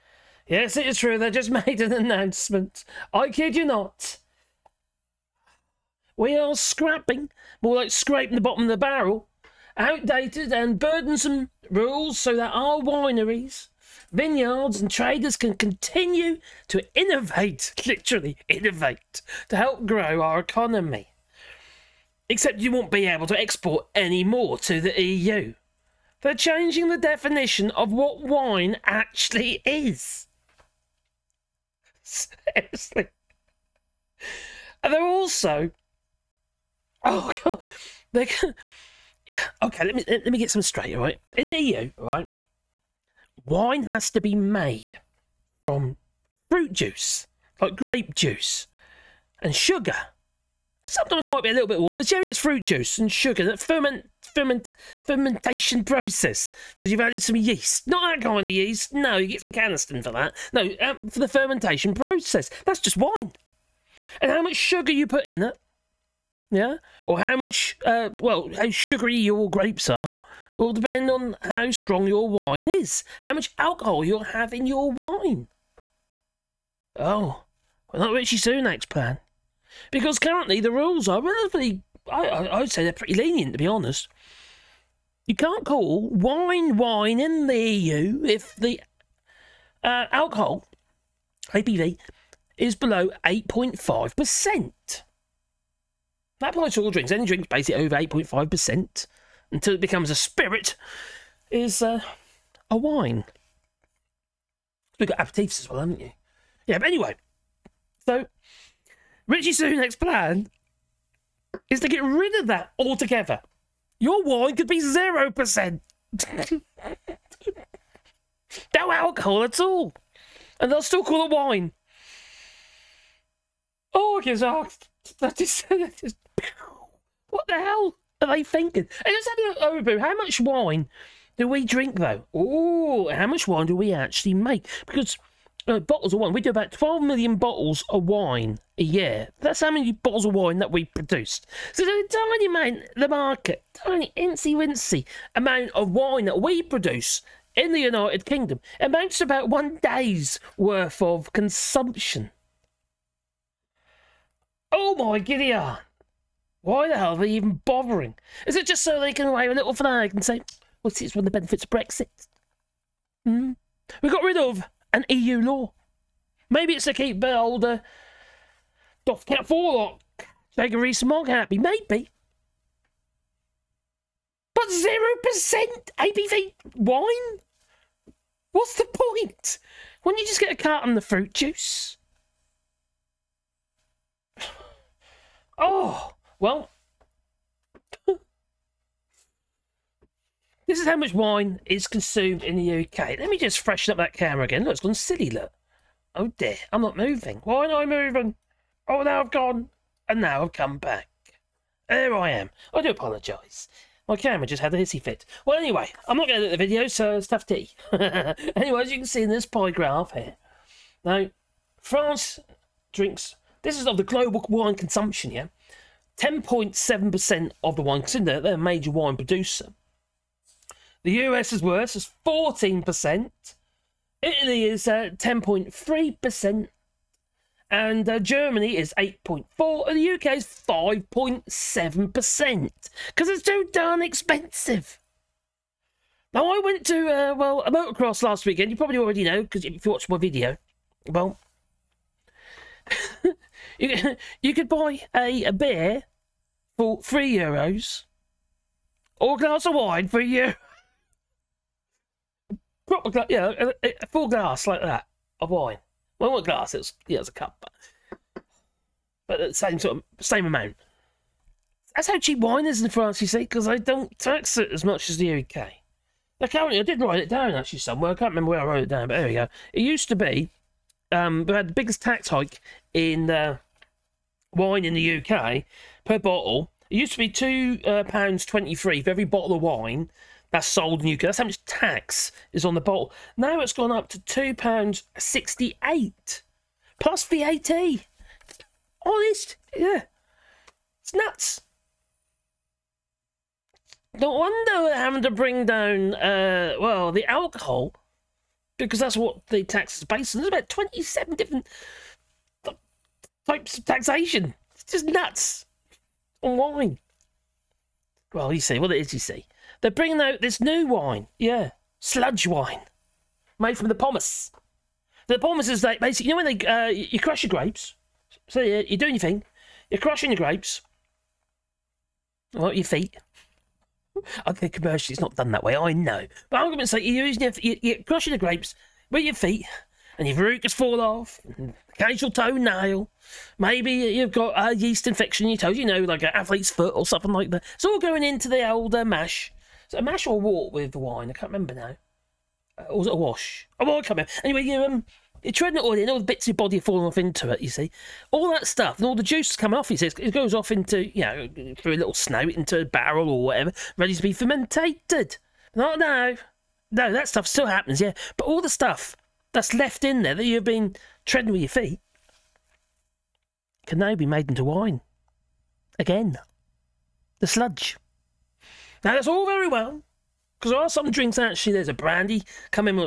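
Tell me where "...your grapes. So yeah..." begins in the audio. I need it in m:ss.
5:17.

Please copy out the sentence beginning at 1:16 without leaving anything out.
Oh, well, not Rishi Sunak's plan.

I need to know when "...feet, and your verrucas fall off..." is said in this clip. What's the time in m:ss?
5:29.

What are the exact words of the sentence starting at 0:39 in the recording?
Okay, let me let me get some straight.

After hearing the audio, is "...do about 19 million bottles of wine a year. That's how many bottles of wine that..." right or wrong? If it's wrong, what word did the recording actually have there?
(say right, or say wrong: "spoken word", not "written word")
wrong: "12", not "19".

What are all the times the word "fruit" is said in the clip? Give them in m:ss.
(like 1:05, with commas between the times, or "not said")
0:46, 0:52, 3:01.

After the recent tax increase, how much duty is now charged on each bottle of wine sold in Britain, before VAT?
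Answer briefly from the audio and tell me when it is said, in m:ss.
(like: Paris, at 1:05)
£2.68, at 4:44.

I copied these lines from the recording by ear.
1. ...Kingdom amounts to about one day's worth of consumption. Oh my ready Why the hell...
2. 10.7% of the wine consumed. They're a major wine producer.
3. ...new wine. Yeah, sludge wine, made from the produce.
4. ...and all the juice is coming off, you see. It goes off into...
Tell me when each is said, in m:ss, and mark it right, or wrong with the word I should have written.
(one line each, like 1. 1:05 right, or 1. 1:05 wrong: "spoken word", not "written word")
1. 2:28 wrong: "giddy", not "ready"
2. 3:36 right
3. 5:10 wrong: "pomace", not "produce"
4. 5:48 right.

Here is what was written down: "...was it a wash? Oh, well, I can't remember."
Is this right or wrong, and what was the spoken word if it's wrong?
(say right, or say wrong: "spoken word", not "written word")
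right.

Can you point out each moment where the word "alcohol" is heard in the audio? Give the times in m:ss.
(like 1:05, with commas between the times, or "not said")
1:13, 1:30, 1:58, 4:57.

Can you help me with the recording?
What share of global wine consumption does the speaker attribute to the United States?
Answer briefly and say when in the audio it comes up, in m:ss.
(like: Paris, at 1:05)
14%, at 3:42.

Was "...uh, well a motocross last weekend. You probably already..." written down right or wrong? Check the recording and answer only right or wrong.
right.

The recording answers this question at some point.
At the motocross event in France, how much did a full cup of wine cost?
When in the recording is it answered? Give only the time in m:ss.
4:10.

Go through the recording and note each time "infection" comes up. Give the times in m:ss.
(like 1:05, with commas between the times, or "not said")
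5:35.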